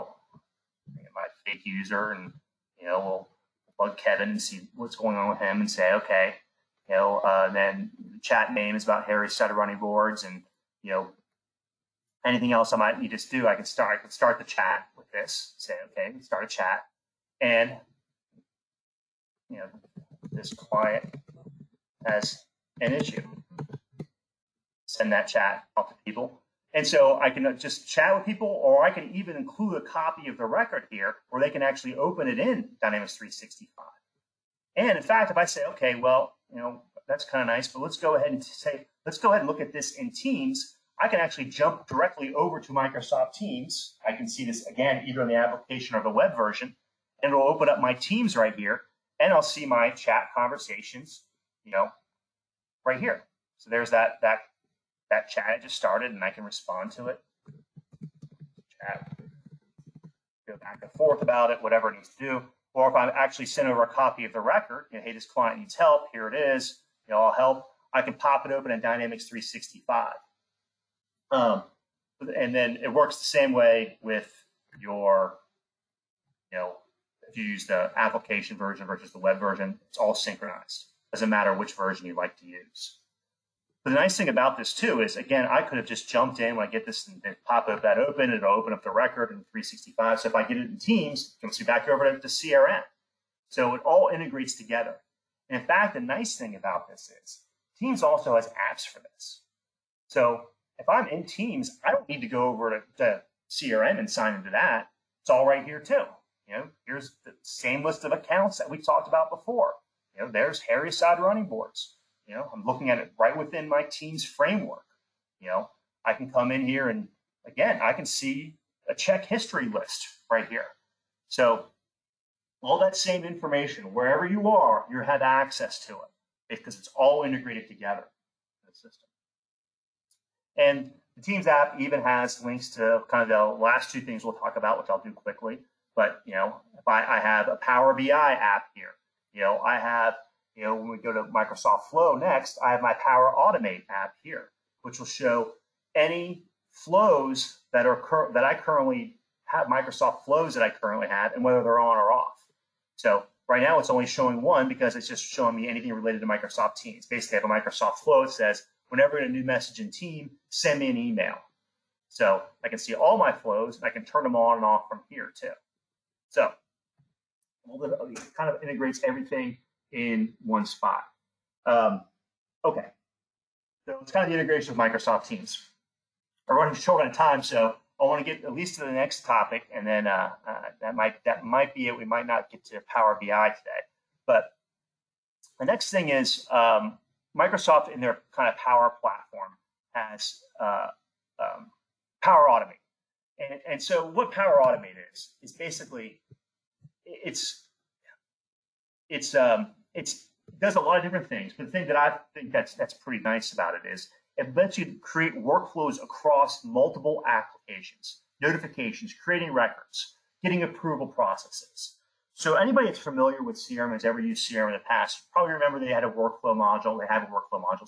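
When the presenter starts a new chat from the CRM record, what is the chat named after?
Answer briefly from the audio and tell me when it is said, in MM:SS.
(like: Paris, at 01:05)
Harry Sutter running boards, at 00:09.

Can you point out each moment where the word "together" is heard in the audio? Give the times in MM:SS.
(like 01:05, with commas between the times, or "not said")
01:34, 02:07.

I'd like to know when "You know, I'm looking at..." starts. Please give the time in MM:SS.
01:52.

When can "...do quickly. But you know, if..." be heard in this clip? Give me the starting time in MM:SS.
02:15.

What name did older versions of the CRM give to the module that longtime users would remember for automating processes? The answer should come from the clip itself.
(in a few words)
workflow module.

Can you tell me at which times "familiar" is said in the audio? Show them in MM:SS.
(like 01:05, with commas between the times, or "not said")
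03:32.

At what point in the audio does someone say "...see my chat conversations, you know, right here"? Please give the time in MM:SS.
00:49.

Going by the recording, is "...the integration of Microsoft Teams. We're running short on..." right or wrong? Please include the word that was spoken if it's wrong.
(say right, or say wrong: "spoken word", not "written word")
right.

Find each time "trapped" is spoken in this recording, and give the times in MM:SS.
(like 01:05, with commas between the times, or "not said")
not said.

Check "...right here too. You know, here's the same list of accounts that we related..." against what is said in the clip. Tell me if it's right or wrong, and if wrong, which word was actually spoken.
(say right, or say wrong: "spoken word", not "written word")
wrong: "talked", not "related".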